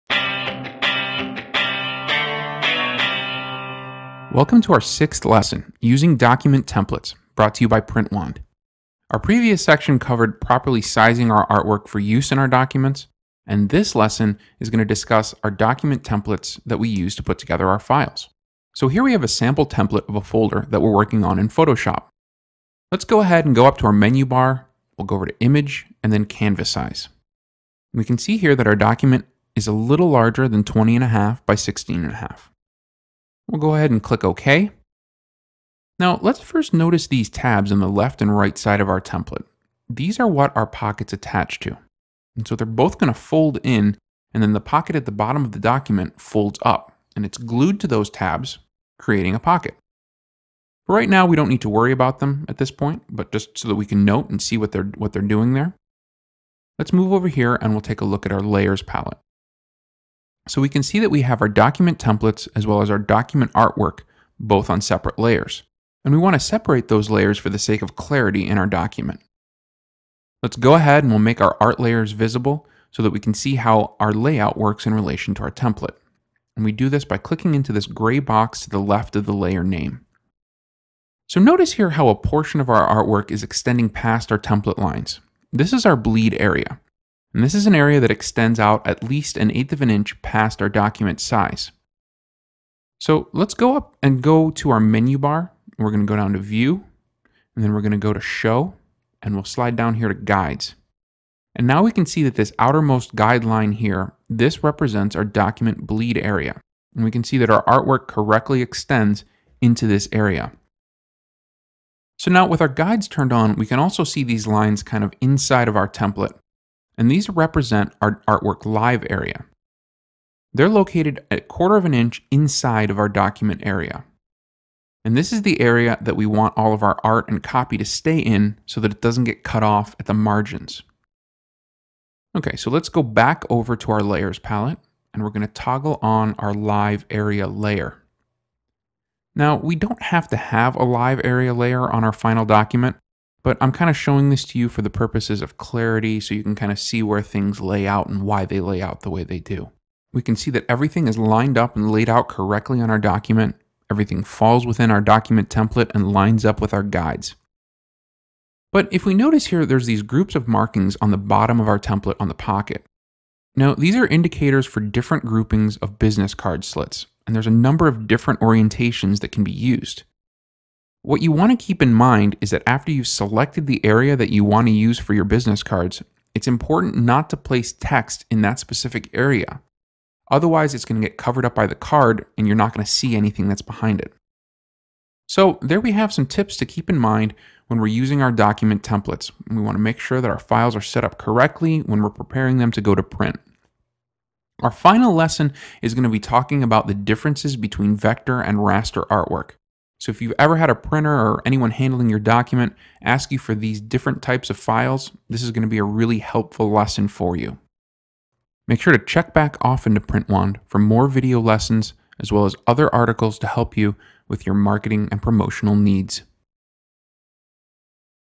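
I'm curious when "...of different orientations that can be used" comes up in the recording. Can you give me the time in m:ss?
2:47.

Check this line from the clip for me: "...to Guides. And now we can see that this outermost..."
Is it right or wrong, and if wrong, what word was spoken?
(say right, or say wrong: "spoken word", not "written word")
right.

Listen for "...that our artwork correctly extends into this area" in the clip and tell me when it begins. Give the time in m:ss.
1:47.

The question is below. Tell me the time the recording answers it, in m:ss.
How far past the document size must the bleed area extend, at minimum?
1:29.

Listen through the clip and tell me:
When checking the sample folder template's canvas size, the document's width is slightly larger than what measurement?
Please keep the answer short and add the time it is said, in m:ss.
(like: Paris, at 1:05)
20 and a half, at 0:30.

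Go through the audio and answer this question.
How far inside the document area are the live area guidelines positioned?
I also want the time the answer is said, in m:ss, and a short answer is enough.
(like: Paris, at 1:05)
a quarter of an inch, at 2:01.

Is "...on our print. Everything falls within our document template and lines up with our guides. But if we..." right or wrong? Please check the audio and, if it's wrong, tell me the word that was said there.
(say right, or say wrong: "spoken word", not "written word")
wrong: "document", not "print".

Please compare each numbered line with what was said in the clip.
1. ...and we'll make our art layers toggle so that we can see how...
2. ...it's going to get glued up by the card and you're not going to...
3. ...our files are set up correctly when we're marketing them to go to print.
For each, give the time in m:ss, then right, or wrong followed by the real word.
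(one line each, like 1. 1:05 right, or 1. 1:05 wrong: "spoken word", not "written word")
1. 1:11 wrong: "visible", not "toggle"
2. 3:00 wrong: "covered", not "glued"
3. 3:10 wrong: "preparing", not "marketing".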